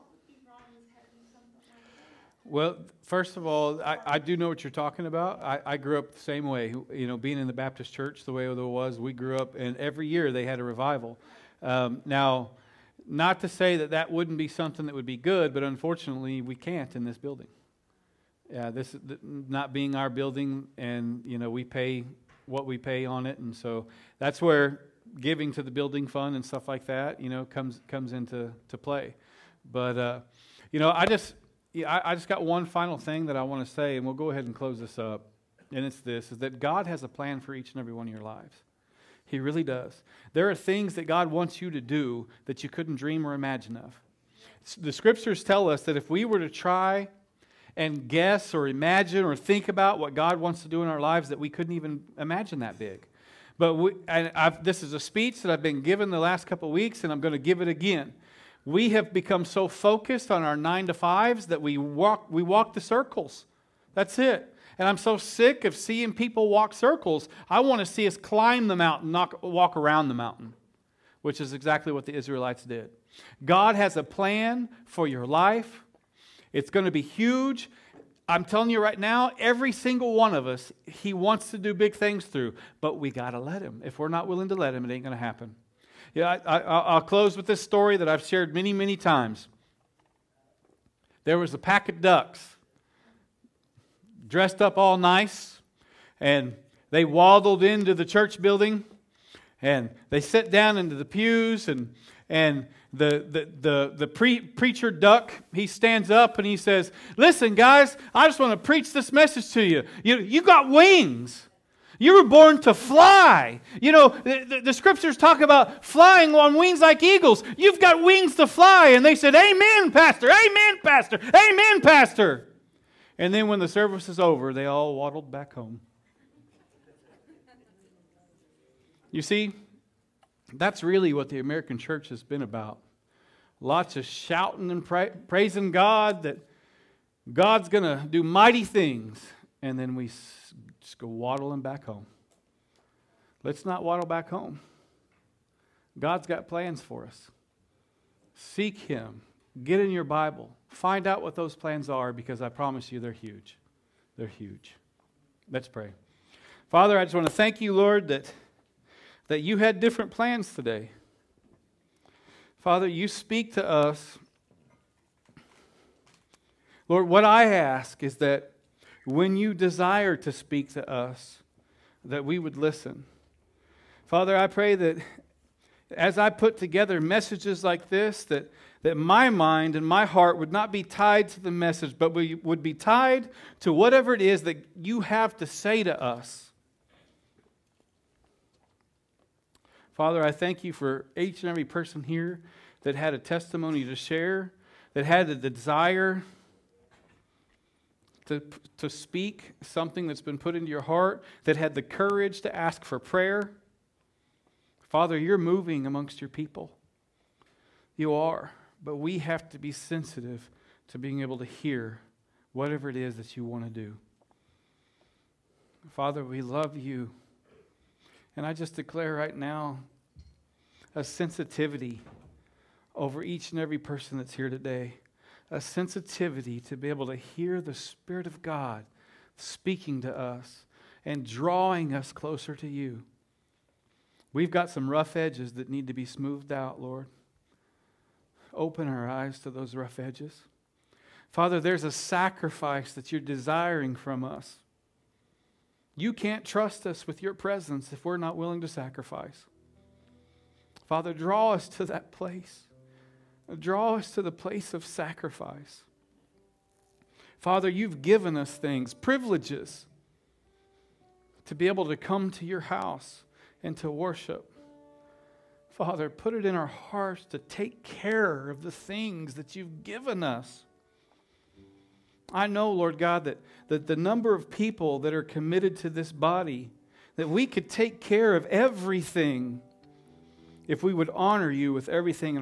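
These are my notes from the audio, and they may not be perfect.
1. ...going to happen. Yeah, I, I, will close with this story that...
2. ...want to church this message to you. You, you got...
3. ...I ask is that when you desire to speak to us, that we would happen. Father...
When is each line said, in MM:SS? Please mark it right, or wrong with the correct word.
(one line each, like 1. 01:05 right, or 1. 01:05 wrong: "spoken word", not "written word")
1. 01:25 right
2. 01:48 wrong: "preach", not "church"
3. 02:47 wrong: "listen", not "happen".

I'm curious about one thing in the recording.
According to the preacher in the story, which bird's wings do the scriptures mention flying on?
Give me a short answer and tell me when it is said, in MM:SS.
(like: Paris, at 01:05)
Eagles, at 01:57.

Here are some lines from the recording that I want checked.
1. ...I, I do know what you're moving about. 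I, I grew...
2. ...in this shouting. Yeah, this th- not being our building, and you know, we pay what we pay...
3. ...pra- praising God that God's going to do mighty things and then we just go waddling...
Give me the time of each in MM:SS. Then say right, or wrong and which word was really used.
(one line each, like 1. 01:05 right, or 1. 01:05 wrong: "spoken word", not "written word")
1. 00:03 wrong: "talking", not "moving"
2. 00:16 wrong: "building", not "shouting"
3. 02:14 right.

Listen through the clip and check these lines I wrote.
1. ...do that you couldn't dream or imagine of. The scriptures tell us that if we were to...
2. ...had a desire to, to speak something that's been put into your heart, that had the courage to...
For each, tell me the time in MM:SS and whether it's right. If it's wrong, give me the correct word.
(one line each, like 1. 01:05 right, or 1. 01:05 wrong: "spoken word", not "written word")
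1. 00:41 right
2. 03:15 right.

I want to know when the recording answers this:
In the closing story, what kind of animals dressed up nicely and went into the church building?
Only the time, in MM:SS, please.
01:32.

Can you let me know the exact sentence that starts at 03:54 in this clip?
We've got some rough edges that need to be smoothed out, Lord.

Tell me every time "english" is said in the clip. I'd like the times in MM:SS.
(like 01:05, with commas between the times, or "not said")
not said.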